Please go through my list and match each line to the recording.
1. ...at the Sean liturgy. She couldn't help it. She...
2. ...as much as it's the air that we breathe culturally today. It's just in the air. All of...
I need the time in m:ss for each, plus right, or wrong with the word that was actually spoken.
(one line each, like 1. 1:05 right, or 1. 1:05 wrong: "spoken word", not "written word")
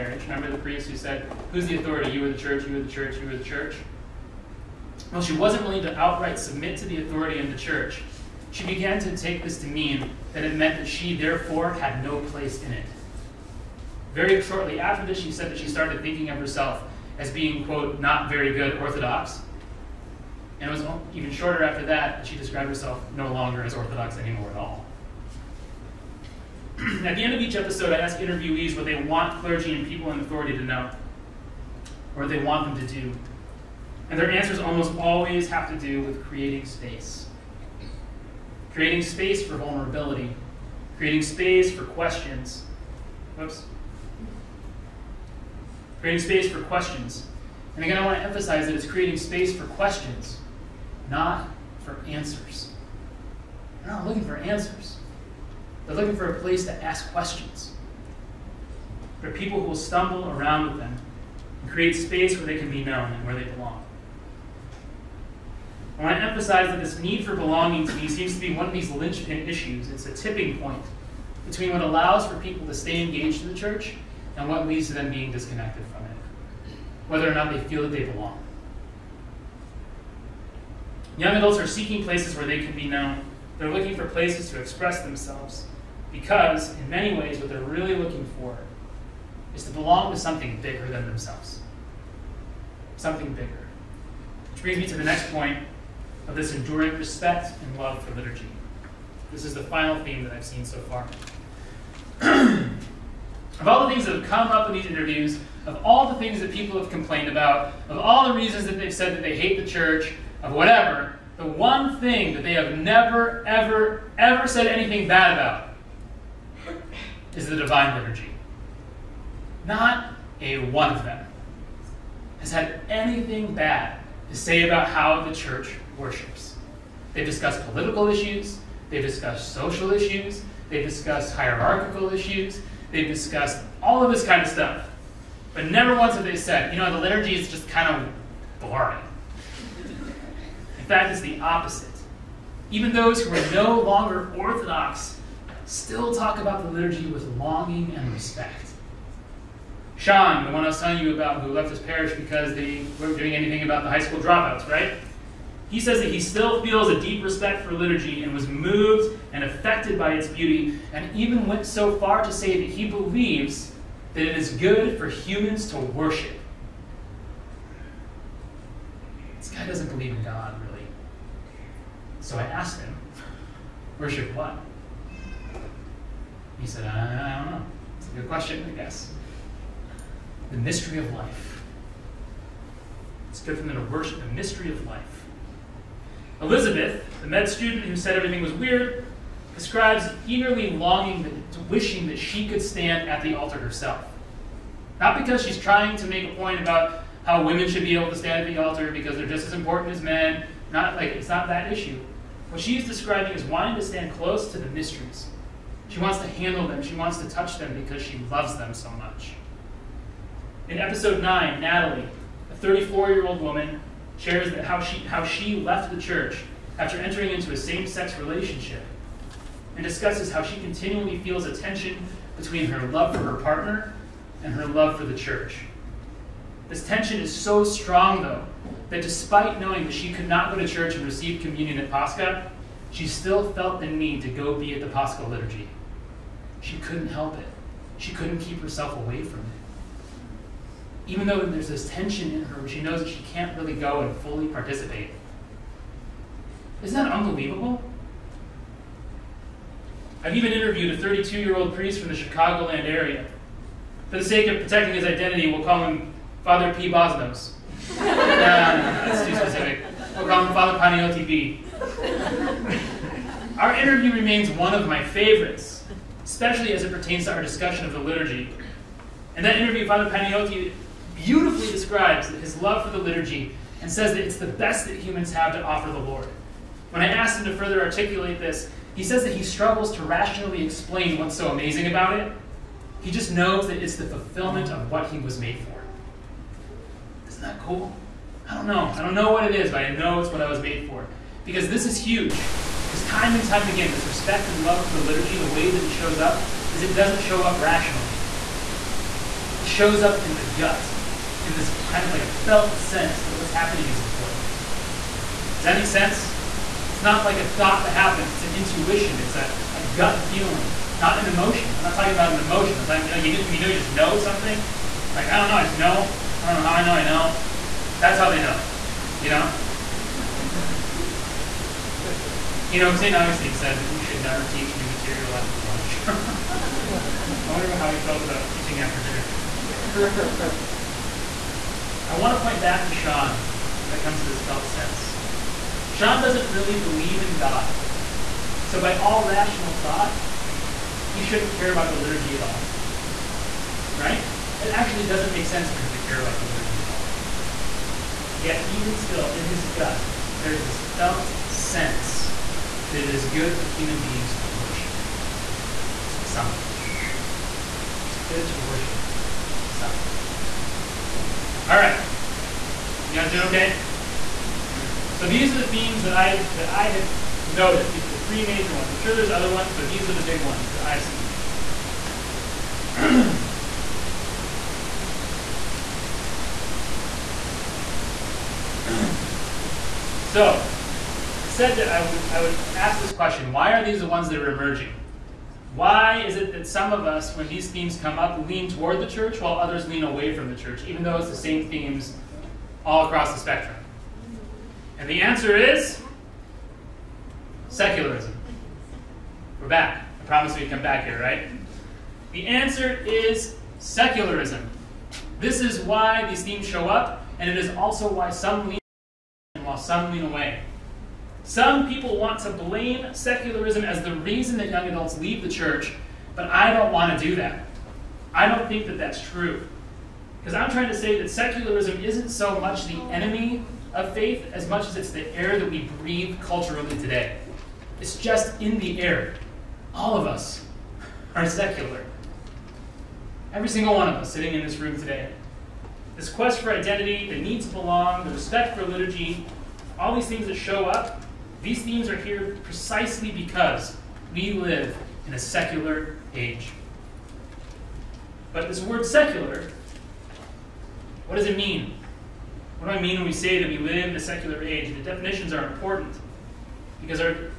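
1. 3:54 wrong: "Paschal", not "Sean"
2. 7:04 right.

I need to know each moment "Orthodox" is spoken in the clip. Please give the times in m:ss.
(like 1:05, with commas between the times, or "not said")
0:18, 0:23, 2:24.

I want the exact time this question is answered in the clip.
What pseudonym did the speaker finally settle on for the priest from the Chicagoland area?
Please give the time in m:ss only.
4:20.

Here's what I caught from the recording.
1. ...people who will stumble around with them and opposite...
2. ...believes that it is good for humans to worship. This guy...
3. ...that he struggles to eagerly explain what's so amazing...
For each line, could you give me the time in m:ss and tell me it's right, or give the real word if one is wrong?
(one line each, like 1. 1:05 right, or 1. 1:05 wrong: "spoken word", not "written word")
1. 0:59 wrong: "create", not "opposite"
2. 2:42 right
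3. 4:39 wrong: "rationally", not "eagerly".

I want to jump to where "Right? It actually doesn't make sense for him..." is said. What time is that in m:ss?
5:43.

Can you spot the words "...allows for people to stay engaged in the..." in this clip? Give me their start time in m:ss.
1:11.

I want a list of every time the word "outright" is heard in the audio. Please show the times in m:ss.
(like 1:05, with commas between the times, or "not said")
0:05.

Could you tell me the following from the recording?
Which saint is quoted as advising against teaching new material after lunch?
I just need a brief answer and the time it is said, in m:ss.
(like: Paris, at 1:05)
St. Augustine, at 5:22.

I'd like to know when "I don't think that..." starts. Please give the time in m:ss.
6:58.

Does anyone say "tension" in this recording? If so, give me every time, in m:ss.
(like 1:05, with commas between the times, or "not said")
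3:41, 3:46, 4:01.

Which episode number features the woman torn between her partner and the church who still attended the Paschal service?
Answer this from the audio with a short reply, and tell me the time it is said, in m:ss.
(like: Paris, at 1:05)
9, at 3:31.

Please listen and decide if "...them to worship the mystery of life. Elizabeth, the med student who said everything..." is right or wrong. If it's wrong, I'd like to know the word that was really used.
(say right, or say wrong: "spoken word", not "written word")
right.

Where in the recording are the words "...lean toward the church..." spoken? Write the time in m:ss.
6:28.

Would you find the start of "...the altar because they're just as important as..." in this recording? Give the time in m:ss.
3:18.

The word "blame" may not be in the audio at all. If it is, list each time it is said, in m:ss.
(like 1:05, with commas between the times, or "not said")
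6:52.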